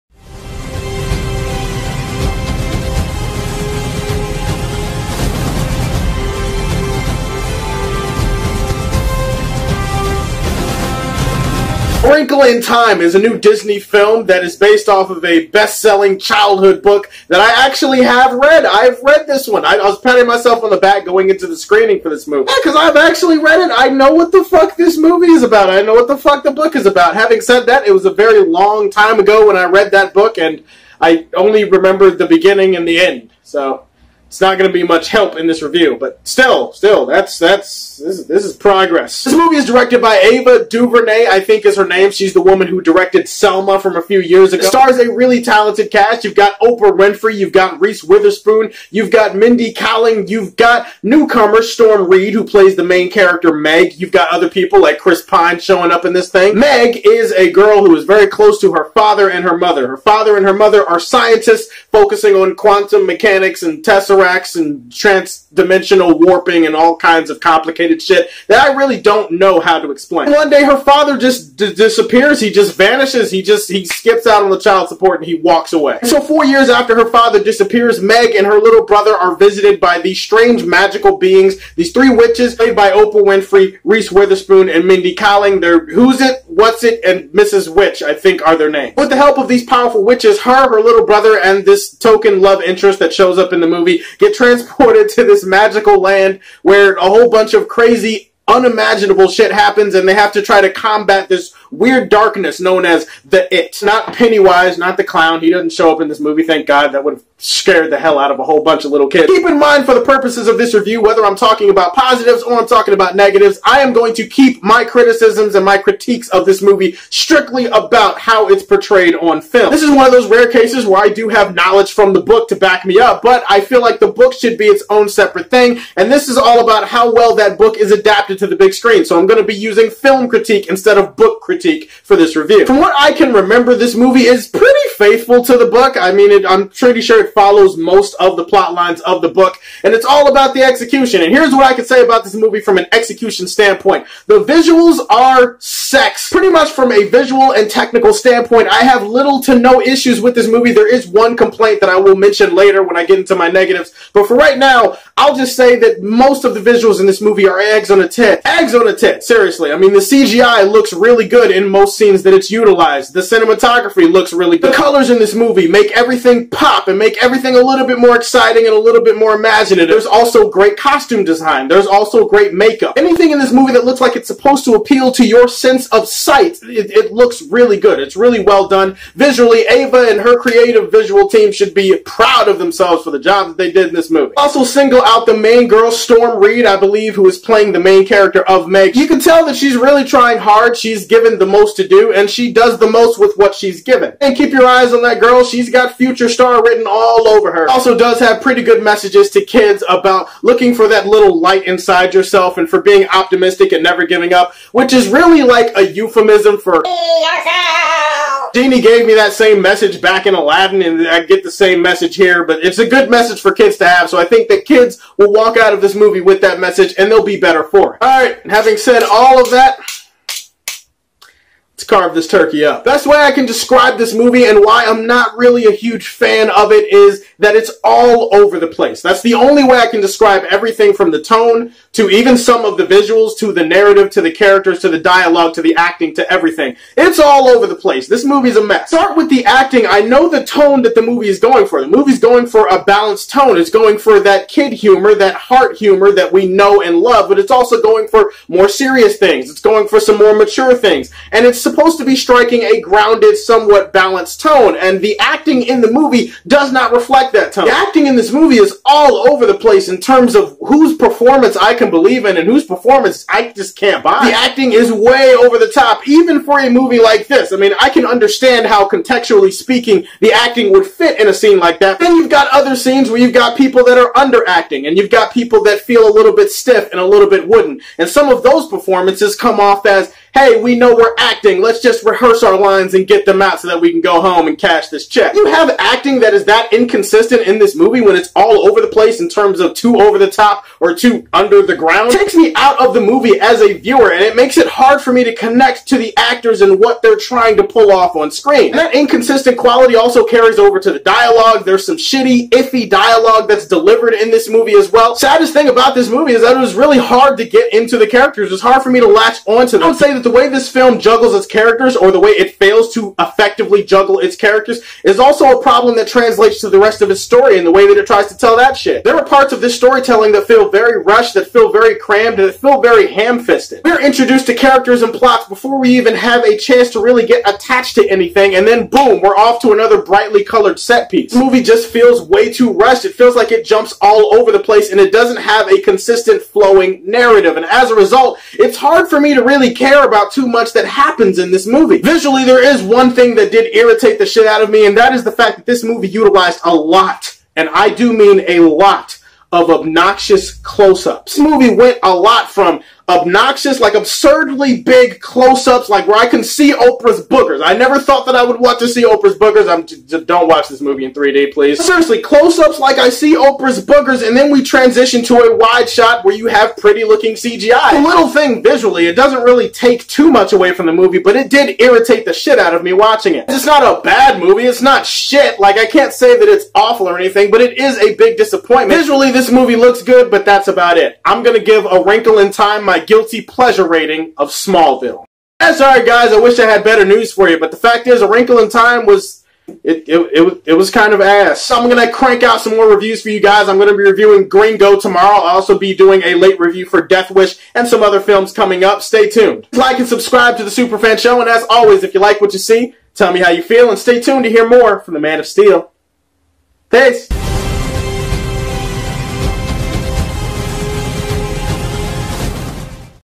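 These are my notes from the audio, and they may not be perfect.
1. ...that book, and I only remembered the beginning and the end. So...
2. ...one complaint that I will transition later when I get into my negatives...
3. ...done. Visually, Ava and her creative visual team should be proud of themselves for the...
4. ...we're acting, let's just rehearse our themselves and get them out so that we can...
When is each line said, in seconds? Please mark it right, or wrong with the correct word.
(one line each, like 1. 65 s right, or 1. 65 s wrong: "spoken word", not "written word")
1. 29 s right
2. 151 s wrong: "mention", not "transition"
3. 178 s right
4. 280 s wrong: "lines", not "themselves".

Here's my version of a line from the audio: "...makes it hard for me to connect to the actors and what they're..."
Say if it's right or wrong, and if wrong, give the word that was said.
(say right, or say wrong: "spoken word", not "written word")
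right.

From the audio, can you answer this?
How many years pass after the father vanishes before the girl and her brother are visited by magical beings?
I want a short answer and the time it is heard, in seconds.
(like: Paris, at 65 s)
4, at 76 s.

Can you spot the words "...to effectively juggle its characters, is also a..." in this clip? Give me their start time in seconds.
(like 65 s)
312 s.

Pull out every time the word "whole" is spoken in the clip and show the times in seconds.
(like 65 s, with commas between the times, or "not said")
97 s, 108 s.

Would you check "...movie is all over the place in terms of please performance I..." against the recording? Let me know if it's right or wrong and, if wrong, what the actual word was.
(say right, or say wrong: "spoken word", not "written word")
wrong: "whose", not "please".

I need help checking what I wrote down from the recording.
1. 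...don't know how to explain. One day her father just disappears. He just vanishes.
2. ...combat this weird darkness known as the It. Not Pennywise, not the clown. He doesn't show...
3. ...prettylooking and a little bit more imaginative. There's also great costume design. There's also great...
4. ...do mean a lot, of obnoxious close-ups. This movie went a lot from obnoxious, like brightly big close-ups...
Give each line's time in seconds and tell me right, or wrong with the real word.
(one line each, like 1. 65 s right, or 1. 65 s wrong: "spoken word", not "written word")
1. 69 s right
2. 100 s right
3. 168 s wrong: "exciting", not "prettylooking"
4. 347 s wrong: "absurdly", not "brightly".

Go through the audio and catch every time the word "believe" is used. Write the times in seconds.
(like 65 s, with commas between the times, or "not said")
186 s, 261 s.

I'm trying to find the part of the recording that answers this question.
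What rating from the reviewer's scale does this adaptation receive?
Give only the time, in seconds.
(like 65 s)
384 s.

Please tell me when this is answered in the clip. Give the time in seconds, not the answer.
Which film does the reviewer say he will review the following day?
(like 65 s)
394 s.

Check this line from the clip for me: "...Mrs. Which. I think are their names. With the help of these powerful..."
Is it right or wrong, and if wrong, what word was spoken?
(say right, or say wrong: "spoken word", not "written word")
right.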